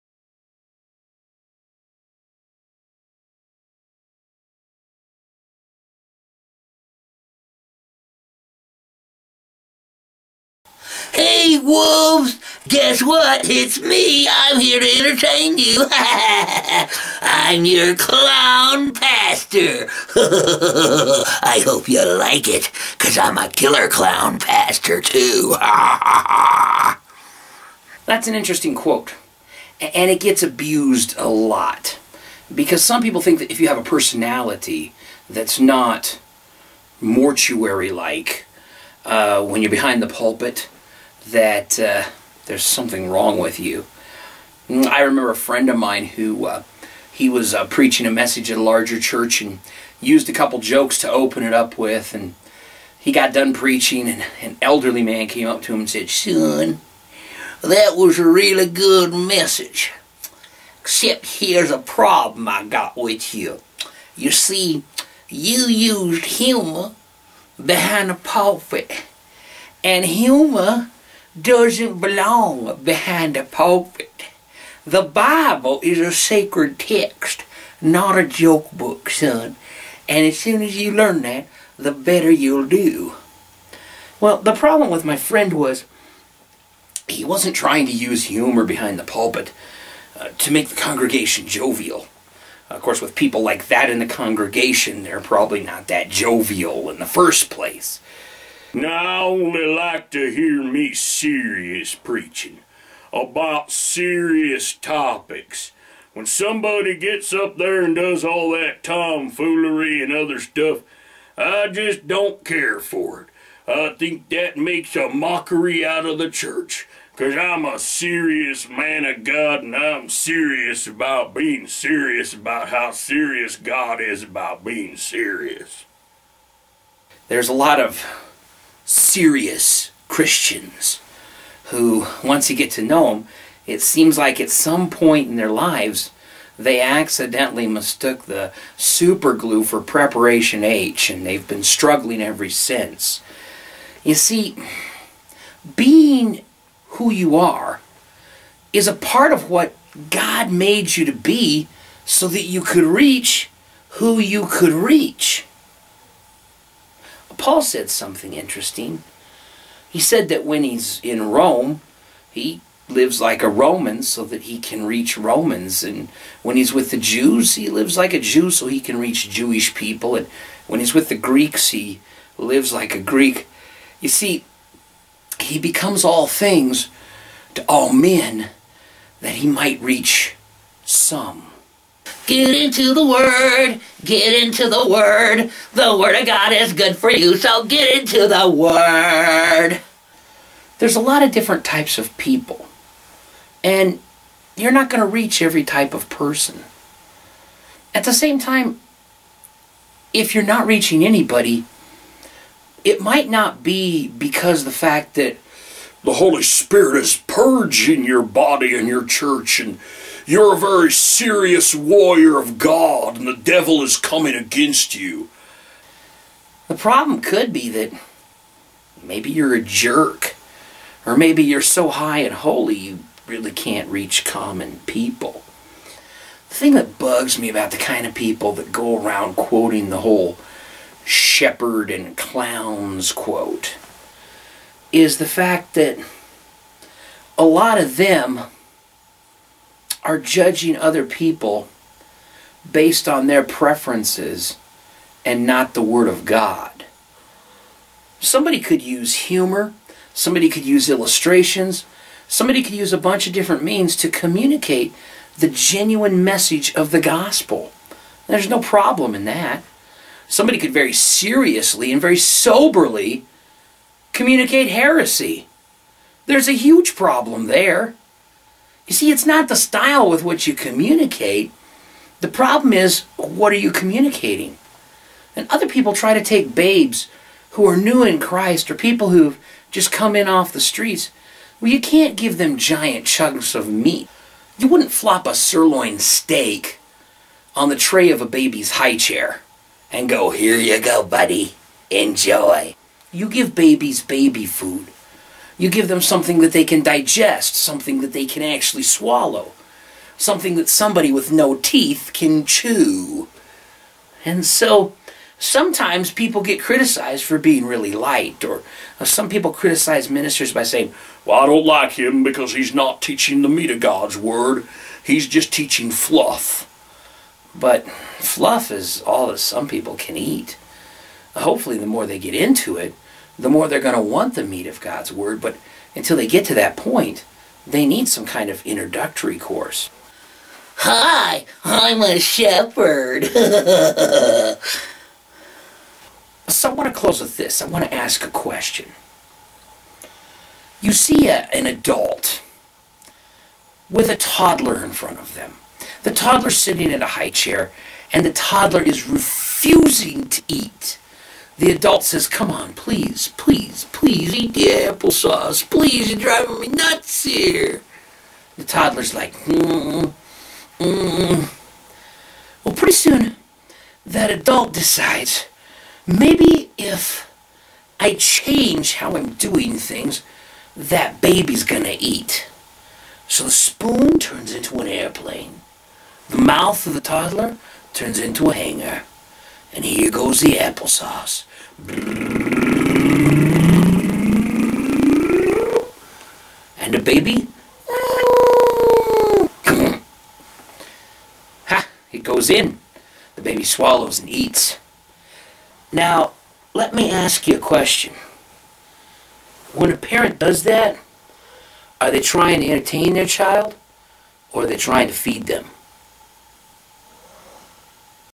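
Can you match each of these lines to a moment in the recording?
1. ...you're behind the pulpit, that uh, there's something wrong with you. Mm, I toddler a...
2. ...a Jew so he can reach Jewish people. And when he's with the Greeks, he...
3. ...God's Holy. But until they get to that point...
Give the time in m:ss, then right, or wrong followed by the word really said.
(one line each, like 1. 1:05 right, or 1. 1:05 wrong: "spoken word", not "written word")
1. 0:39 wrong: "remember", not "toddler"
2. 2:48 right
3. 5:24 wrong: "Word", not "Holy".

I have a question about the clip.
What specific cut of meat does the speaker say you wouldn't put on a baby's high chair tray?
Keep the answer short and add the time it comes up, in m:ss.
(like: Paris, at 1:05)
sirloin steak, at 4:45.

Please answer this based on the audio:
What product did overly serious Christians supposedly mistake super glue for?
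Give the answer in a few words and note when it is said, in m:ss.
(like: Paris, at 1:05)
Preparation H, at 2:19.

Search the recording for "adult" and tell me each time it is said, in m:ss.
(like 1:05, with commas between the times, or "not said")
5:41, 5:51, 6:04.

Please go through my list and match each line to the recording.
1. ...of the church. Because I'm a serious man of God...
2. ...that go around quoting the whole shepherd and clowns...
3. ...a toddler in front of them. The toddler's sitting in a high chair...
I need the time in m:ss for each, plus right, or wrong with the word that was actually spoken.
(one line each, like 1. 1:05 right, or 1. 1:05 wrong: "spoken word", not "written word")
1. 1:56 right
2. 3:48 right
3. 5:44 right.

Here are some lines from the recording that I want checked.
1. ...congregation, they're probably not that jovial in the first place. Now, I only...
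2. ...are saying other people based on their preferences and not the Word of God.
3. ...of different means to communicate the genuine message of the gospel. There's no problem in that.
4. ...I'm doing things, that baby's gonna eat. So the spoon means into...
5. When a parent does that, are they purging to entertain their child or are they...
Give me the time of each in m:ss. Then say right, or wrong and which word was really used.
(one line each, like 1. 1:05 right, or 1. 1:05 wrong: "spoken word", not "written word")
1. 1:34 right
2. 4:00 wrong: "judging", not "saying"
3. 4:13 right
4. 6:09 wrong: "turns", not "means"
5. 6:39 wrong: "trying", not "purging".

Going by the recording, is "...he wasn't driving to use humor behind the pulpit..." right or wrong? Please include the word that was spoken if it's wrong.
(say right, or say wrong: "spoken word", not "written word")
wrong: "trying", not "driving".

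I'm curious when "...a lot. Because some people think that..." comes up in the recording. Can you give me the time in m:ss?
0:31.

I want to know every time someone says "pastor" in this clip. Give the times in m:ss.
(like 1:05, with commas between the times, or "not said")
0:18, 0:24.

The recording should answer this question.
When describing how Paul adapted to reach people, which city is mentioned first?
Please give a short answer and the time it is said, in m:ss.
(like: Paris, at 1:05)
Rome, at 2:41.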